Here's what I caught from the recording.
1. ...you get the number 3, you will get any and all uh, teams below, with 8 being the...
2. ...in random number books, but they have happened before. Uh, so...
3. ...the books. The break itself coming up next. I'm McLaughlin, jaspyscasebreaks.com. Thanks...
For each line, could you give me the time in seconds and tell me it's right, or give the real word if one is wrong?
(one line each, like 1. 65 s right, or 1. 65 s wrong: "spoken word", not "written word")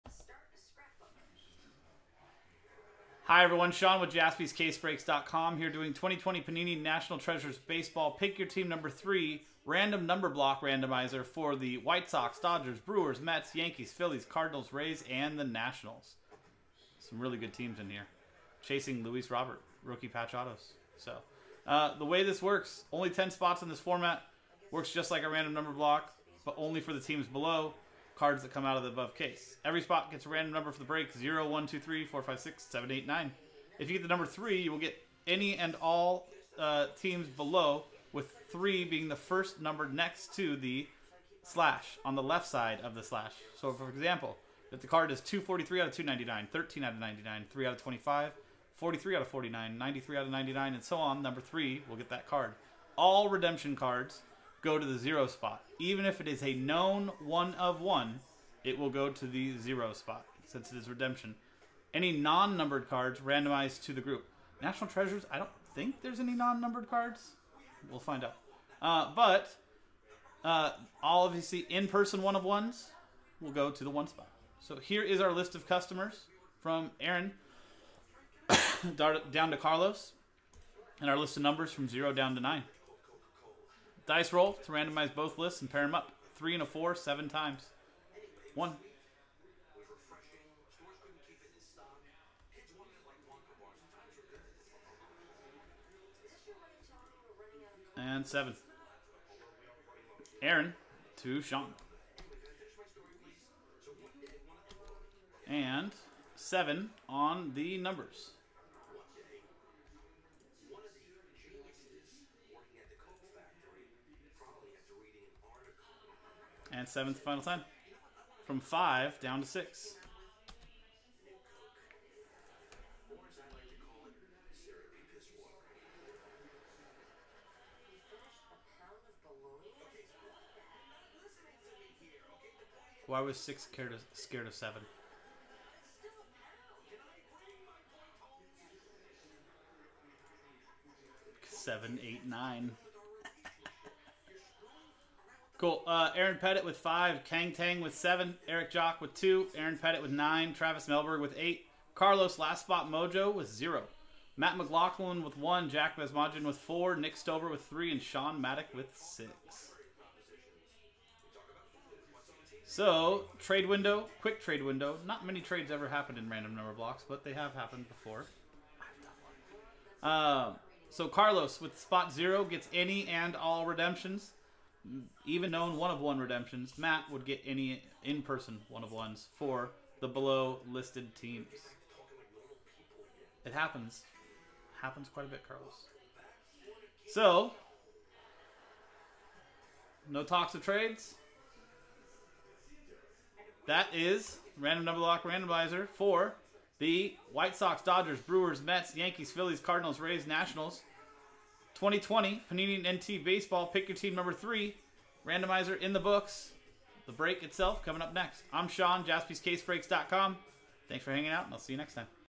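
1. 33 s wrong: "3", not "8"
2. 166 s wrong: "blocks", not "books"
3. 205 s wrong: "Sean", not "McLaughlin".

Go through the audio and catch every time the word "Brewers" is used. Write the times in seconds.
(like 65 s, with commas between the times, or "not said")
12 s, 198 s.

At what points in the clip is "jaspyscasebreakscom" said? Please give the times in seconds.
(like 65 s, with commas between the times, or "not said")
4 s, 209 s.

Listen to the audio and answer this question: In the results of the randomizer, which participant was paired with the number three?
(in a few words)
Nick Stover.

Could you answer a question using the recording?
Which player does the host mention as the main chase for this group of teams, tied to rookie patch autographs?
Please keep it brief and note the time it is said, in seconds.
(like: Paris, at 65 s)
Luis Robert, at 19 s.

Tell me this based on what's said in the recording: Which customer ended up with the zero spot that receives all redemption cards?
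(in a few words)
Carlos Last Spot Mojo.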